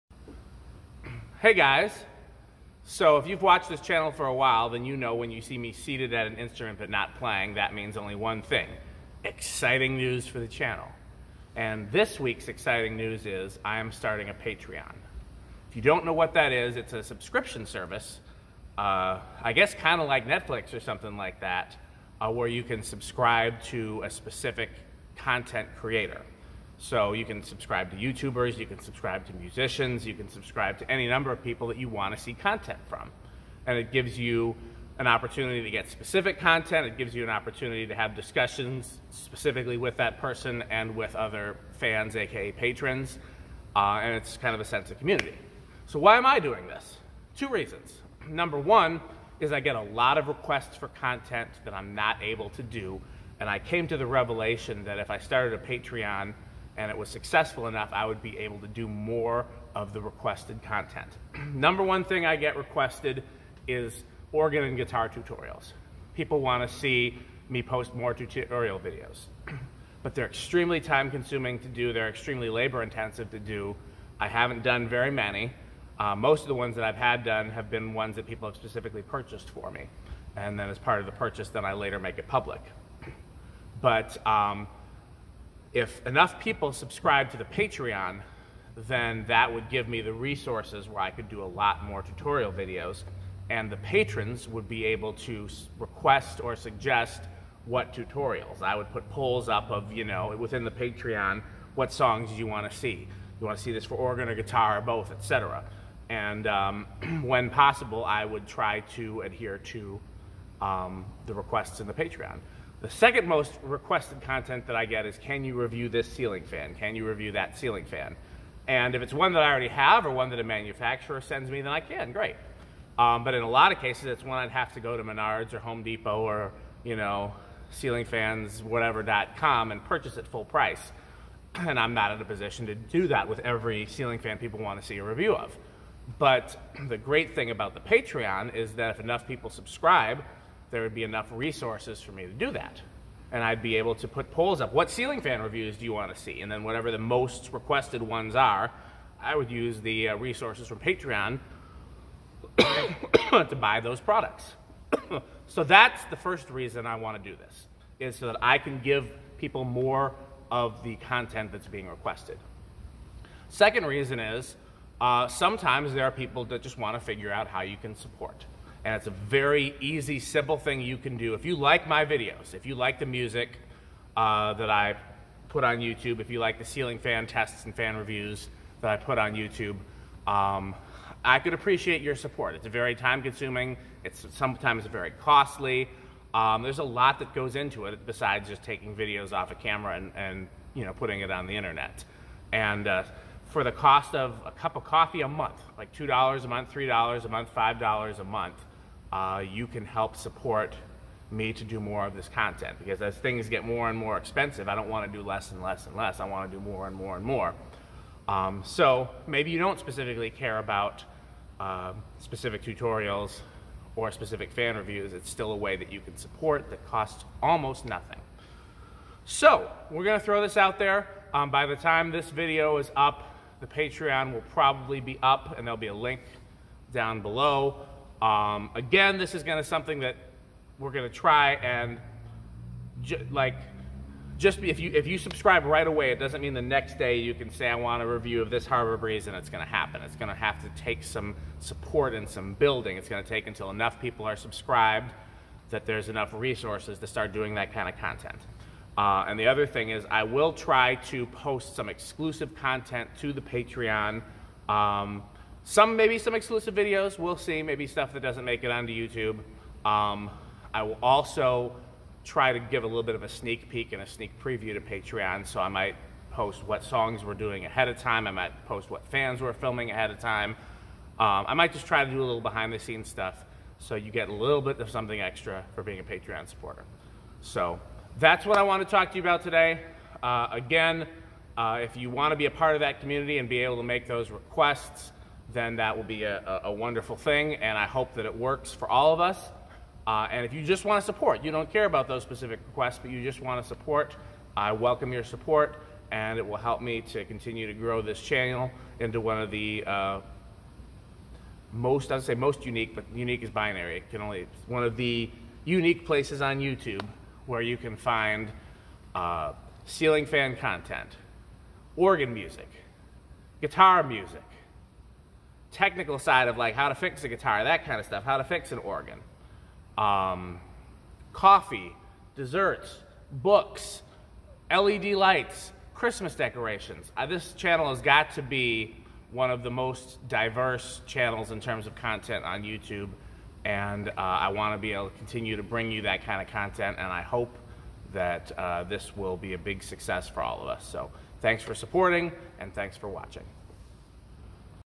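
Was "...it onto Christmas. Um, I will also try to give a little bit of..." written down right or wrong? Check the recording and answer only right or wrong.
wrong.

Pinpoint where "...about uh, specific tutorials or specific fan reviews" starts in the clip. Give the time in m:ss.
3:30.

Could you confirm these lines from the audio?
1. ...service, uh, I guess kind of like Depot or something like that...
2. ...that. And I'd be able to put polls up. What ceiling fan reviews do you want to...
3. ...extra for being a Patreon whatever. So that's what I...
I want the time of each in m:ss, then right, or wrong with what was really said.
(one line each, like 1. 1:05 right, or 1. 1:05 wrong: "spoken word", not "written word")
1. 0:17 wrong: "Netflix", not "Depot"
2. 2:22 right
3. 4:35 wrong: "supporter", not "whatever".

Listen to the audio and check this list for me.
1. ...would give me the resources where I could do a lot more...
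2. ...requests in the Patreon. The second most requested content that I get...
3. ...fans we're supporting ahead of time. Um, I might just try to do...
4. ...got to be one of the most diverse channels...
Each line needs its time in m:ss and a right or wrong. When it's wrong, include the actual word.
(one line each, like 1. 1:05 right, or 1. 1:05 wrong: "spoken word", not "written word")
1. 1:29 right
2. 1:51 right
3. 4:29 wrong: "filming", not "supporting"
4. 5:28 right.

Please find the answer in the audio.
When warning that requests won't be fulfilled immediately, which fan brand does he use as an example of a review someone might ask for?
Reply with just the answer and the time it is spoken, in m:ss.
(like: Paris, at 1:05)
Harbor Breeze, at 3:58.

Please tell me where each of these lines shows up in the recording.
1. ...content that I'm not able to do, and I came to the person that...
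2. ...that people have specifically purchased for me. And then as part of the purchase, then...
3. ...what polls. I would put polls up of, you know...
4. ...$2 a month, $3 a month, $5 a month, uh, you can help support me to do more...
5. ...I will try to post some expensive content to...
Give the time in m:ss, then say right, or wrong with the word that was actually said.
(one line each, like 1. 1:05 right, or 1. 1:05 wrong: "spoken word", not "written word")
1. 0:50 wrong: "revelation", not "person"
2. 1:18 right
3. 1:37 wrong: "tutorials", not "polls"
4. 3:15 right
5. 4:10 wrong: "exclusive", not "expensive".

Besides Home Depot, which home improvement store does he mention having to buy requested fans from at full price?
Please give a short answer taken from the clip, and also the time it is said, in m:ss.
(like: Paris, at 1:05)
Menards, at 2:05.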